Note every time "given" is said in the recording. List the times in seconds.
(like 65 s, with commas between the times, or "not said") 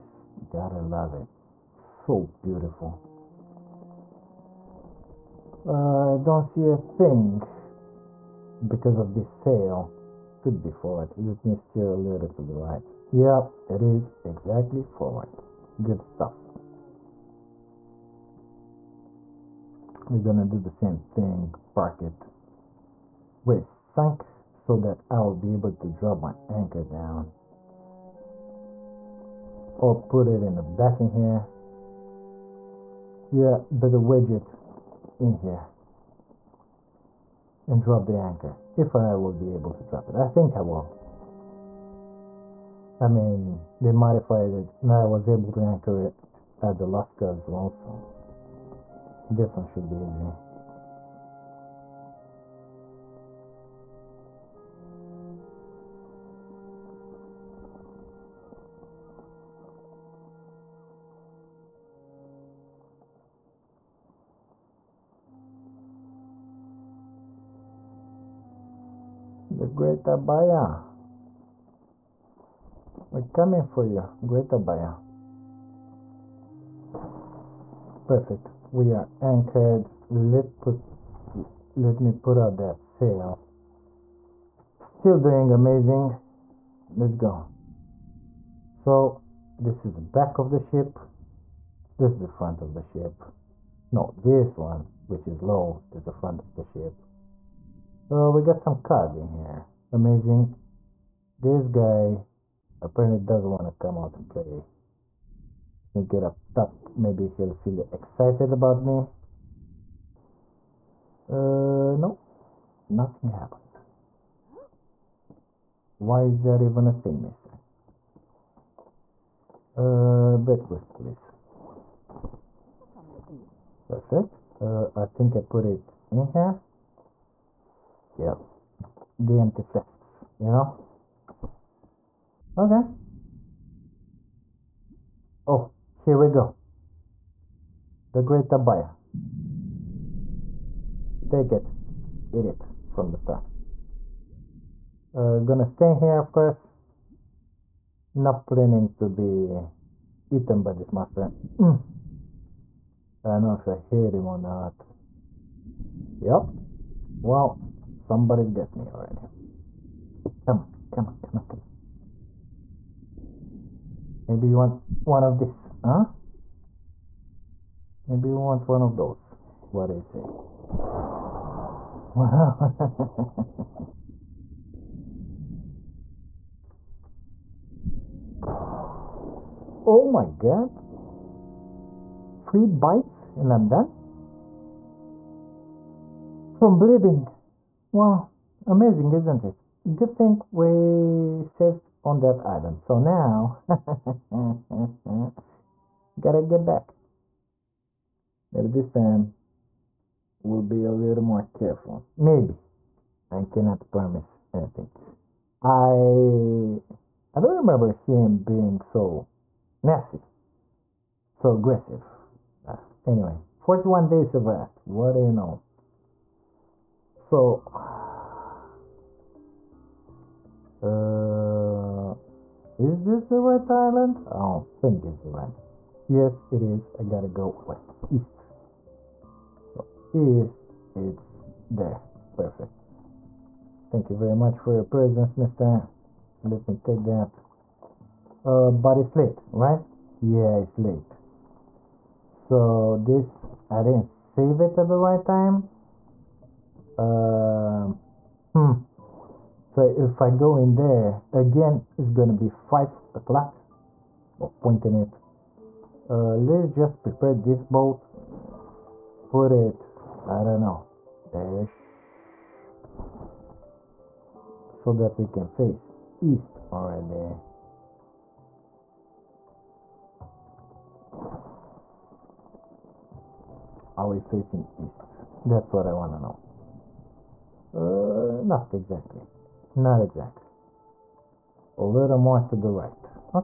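not said.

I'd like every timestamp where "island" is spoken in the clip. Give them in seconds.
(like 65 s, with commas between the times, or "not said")
192 s, 223 s.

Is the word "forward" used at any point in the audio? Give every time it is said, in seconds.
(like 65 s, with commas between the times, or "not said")
10 s, 14 s.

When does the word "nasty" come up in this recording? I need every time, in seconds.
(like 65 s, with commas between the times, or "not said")
209 s.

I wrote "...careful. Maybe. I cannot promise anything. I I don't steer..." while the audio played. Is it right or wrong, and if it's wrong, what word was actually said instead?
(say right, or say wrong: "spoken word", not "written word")
wrong: "remember", not "steer".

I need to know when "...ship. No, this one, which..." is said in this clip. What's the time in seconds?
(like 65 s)
92 s.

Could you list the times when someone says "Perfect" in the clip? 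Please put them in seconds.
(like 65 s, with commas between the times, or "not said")
78 s, 123 s, 232 s.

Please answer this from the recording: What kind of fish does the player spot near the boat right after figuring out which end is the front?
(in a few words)
Cod.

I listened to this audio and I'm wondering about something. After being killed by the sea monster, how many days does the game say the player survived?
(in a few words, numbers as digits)
41.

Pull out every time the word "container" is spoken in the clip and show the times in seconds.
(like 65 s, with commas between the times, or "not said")
not said.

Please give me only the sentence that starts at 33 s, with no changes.
Yeah, but the widget in here.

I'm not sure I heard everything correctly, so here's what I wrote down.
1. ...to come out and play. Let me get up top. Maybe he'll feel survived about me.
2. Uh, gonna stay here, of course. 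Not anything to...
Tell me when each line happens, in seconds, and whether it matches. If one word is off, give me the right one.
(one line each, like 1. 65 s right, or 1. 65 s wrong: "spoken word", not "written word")
1. 103 s wrong: "excited", not "survived"
2. 145 s wrong: "planning", not "anything".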